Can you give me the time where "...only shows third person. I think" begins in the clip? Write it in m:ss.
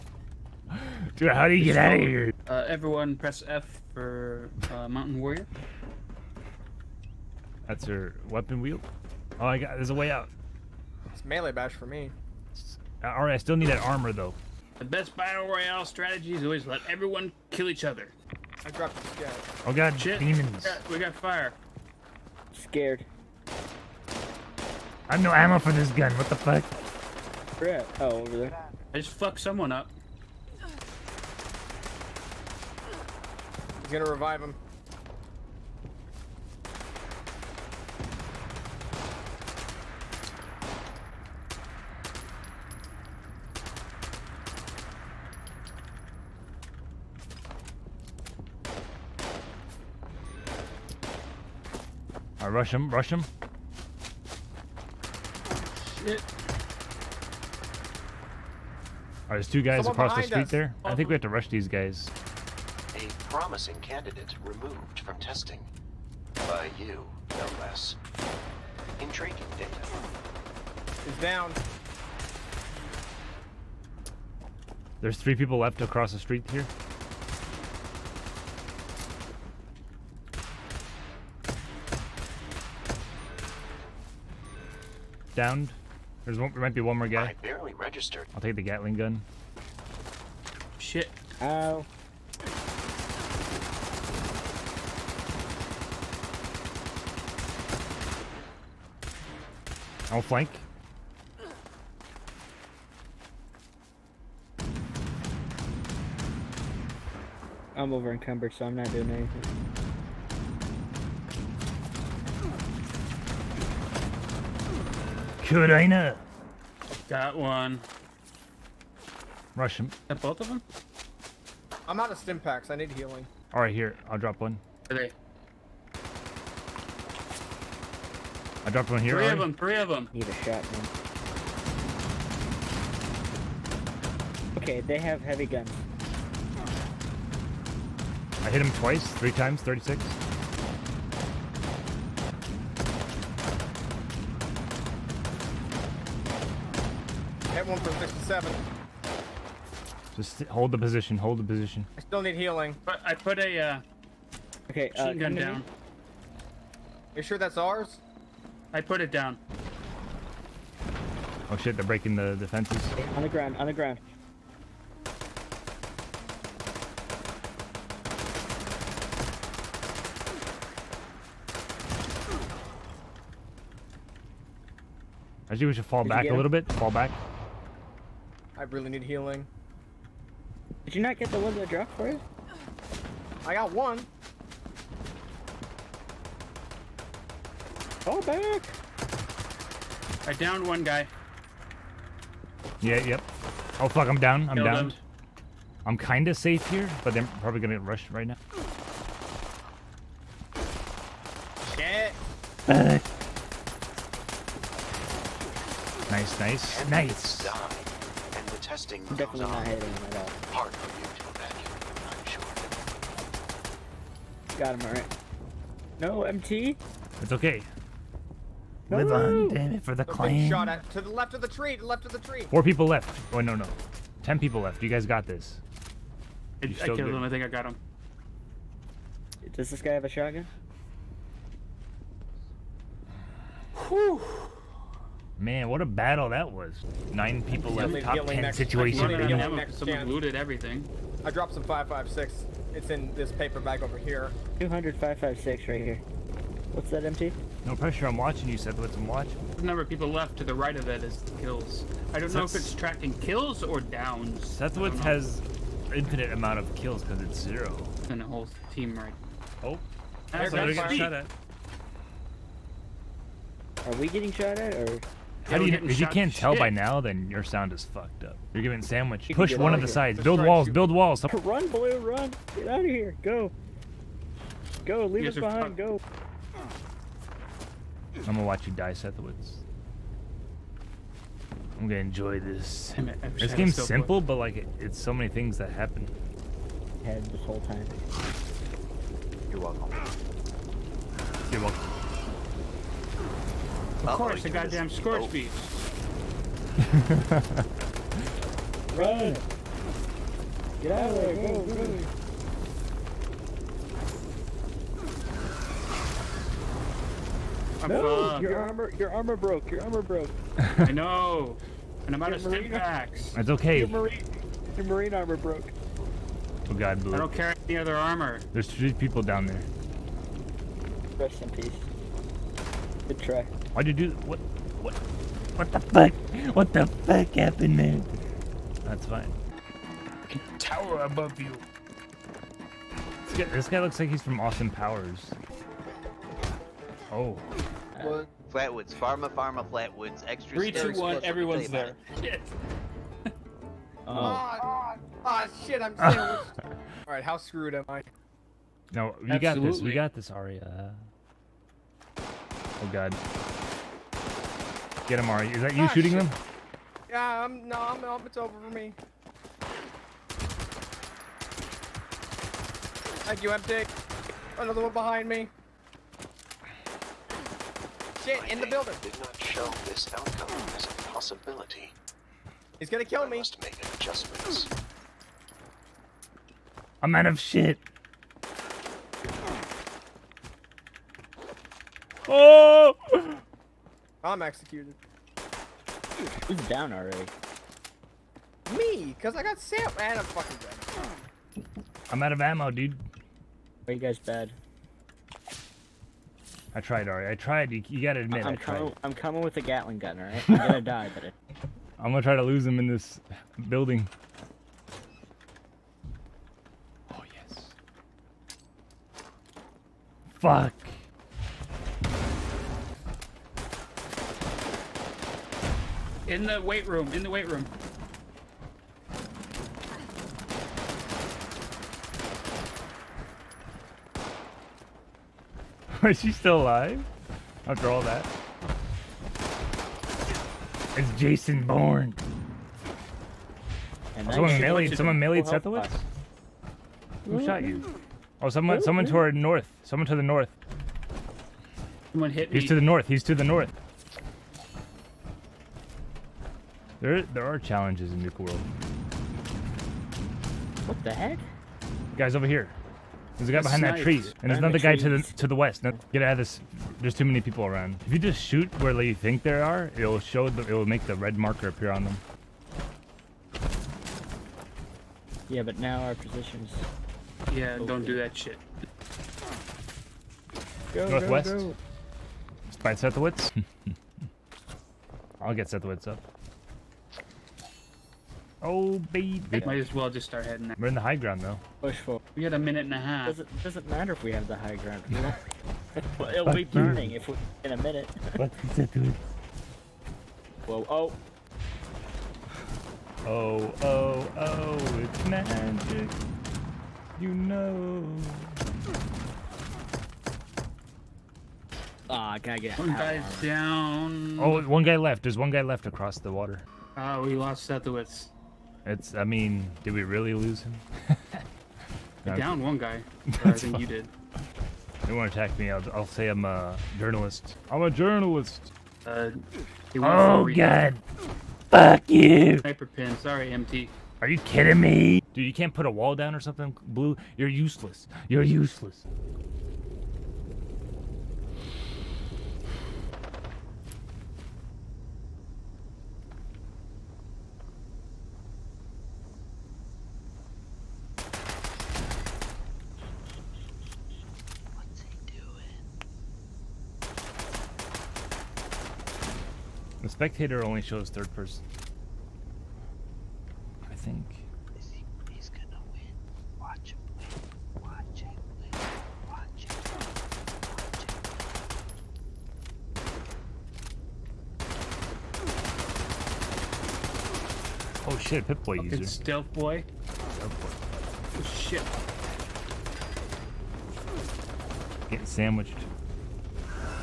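9:10.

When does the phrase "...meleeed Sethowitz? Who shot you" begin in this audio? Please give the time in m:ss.
7:15.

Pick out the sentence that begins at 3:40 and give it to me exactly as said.
Shot at to the left of the tree, to the left of the tree.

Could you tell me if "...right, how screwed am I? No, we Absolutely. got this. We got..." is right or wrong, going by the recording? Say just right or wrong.
right.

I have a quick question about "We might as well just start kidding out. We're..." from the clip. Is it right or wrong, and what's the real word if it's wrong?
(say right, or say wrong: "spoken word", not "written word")
wrong: "heading", not "kidding".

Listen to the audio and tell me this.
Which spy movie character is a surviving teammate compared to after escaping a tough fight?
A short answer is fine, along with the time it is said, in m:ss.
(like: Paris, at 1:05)
Jason Bourne, at 7:10.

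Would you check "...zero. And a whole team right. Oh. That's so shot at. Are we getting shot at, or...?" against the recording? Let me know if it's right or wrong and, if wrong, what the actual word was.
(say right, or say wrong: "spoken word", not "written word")
right.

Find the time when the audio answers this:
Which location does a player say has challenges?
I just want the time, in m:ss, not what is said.
7:27.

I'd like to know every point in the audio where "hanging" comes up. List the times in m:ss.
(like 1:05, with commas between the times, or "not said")
not said.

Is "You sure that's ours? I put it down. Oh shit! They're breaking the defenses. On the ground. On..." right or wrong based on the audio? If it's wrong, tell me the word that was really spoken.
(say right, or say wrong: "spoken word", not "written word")
right.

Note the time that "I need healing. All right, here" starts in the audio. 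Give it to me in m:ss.
2:02.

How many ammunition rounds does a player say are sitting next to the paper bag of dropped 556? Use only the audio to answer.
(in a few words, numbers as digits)
200.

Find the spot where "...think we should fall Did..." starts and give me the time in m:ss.
2:55.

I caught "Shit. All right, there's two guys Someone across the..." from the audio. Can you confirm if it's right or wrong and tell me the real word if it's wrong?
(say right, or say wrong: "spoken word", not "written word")
right.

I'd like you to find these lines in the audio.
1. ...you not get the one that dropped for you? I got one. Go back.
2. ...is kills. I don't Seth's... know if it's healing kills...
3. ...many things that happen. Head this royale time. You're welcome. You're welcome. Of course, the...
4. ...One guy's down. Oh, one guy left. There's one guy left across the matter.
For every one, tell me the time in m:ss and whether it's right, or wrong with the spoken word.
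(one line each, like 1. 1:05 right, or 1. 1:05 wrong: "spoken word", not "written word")
1. 3:00 right
2. 4:11 wrong: "tracking", not "healing"
3. 4:45 wrong: "whole", not "royale"
4. 8:22 wrong: "water", not "matter".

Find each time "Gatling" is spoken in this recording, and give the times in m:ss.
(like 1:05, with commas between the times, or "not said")
1:28, 6:39.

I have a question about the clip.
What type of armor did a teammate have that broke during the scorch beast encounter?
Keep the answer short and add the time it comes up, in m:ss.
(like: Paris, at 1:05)
Marine armor, at 5:13.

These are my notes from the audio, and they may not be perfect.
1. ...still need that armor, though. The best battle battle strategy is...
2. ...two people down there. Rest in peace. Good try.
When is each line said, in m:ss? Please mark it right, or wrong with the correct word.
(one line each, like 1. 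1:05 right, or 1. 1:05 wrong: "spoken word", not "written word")
1. 0:13 wrong: "royale", not "battle"
2. 5:18 wrong: "three", not "two".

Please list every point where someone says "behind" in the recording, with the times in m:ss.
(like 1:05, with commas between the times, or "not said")
4:35, 6:04, 7:33.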